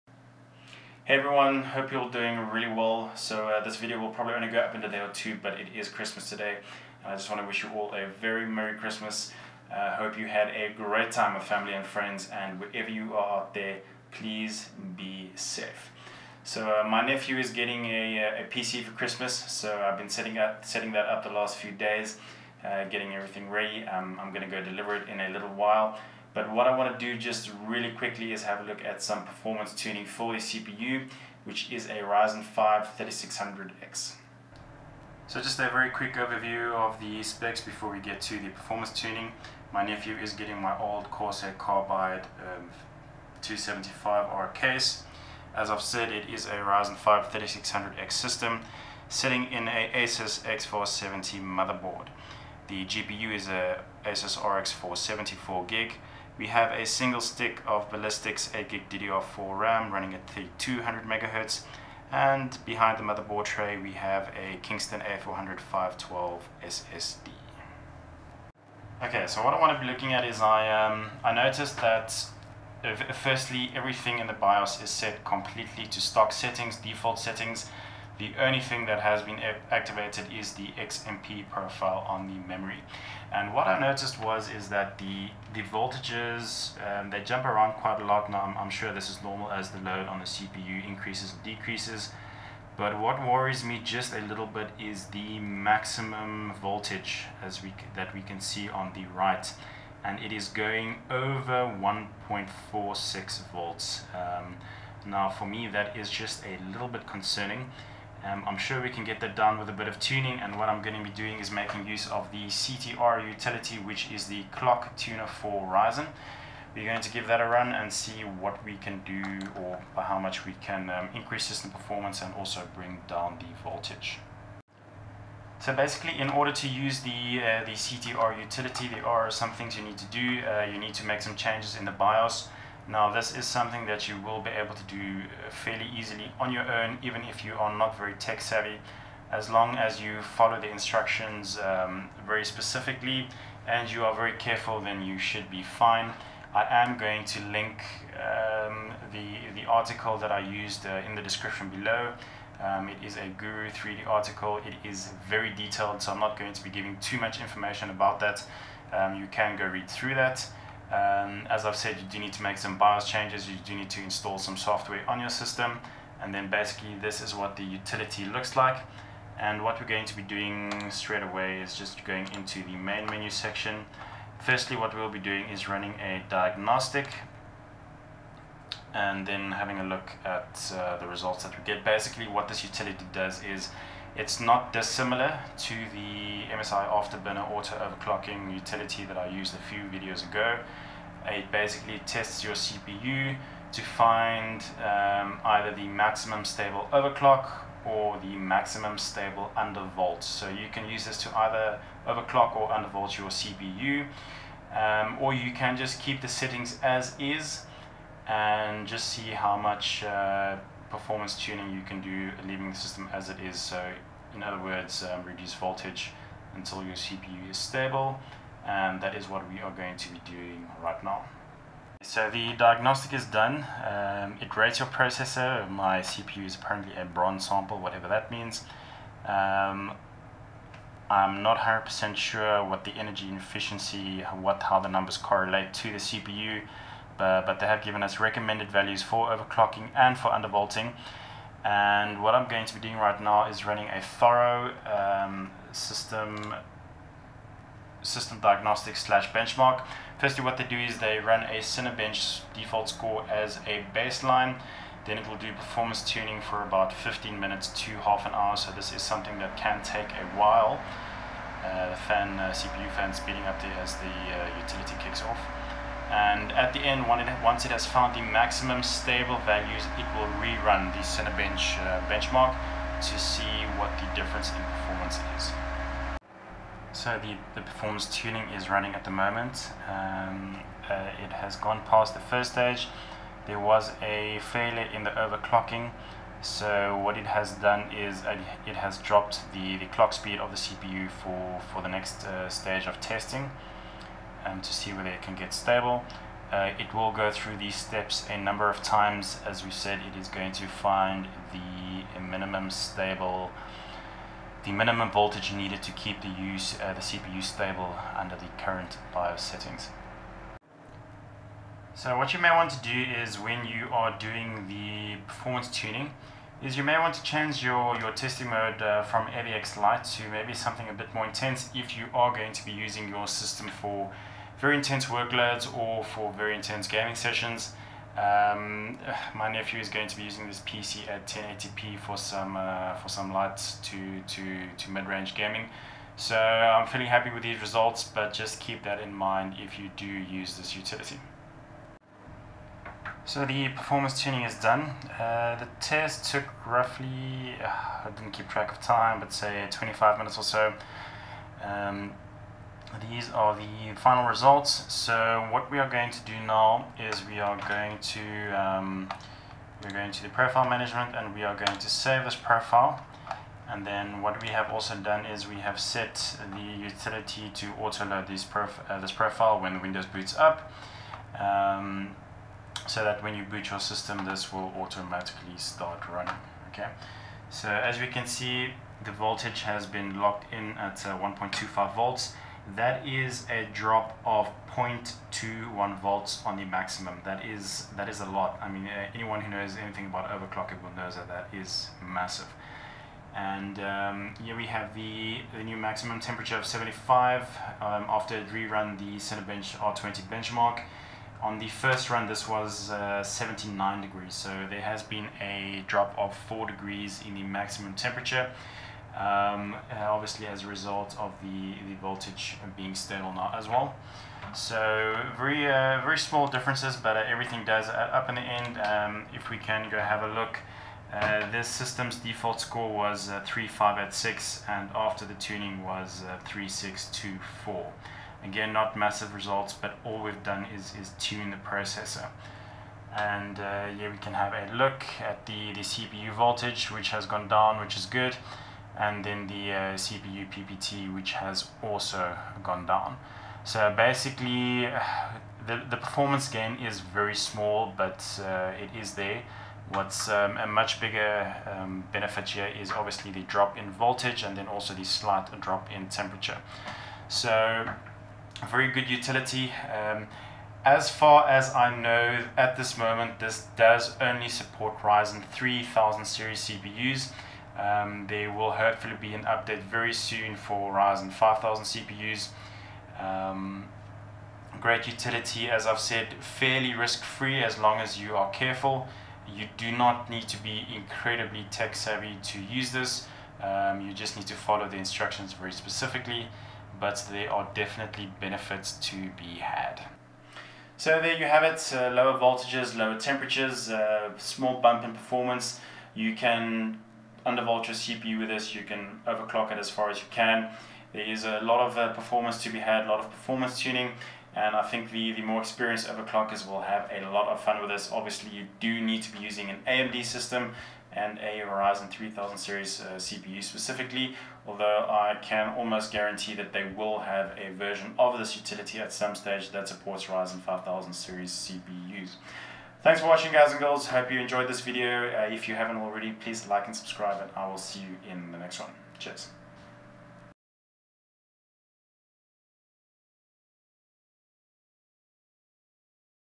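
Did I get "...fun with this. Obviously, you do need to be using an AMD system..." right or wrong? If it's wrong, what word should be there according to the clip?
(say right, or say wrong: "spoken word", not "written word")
right.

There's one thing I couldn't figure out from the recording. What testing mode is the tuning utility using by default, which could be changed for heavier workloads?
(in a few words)
AVX Lite.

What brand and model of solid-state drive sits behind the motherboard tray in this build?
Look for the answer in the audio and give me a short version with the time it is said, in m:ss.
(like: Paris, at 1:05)
Kingston A400, at 1:04.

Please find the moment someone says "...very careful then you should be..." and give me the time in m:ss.
2:24.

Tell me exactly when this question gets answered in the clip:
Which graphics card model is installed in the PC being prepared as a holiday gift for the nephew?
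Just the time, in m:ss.
0:54.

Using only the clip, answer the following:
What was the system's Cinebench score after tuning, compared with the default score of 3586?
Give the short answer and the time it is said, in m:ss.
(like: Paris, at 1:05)
3624, at 7:06.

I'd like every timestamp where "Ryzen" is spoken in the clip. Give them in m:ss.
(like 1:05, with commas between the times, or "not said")
0:32, 0:46, 1:55, 7:44, 7:50, 8:31, 8:40.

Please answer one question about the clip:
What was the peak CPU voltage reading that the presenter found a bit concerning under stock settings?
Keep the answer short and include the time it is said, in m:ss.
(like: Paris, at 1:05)
1.46 volts, at 1:41.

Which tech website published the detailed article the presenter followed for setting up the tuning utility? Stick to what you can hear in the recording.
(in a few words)
Guru3D.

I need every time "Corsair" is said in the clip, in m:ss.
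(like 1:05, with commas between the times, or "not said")
0:41.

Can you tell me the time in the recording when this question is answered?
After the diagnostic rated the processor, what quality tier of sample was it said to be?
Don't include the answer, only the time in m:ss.
3:47.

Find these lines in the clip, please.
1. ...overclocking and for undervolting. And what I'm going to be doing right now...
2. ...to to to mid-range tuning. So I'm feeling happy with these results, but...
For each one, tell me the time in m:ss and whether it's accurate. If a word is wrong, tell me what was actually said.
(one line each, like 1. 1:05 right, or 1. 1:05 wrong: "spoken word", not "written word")
1. 3:59 right
2. 5:33 wrong: "gaming", not "tuning".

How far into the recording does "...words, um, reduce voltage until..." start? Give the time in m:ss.
3:34.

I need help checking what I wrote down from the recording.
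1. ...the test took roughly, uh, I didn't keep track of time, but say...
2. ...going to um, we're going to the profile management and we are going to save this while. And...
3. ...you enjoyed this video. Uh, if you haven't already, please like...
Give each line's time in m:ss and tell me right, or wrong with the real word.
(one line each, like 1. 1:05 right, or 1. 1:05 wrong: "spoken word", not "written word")
1. 5:45 right
2. 5:57 wrong: "profile", not "while"
3. 8:44 right.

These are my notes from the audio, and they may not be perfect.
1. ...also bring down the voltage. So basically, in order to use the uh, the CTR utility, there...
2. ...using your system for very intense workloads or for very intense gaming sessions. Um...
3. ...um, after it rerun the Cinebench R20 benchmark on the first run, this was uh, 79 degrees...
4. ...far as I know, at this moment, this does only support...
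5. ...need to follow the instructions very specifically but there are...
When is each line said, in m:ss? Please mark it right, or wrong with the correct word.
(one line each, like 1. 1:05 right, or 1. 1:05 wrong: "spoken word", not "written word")
1. 2:02 right
2. 5:22 right
3. 6:37 right
4. 7:41 right
5. 8:04 right.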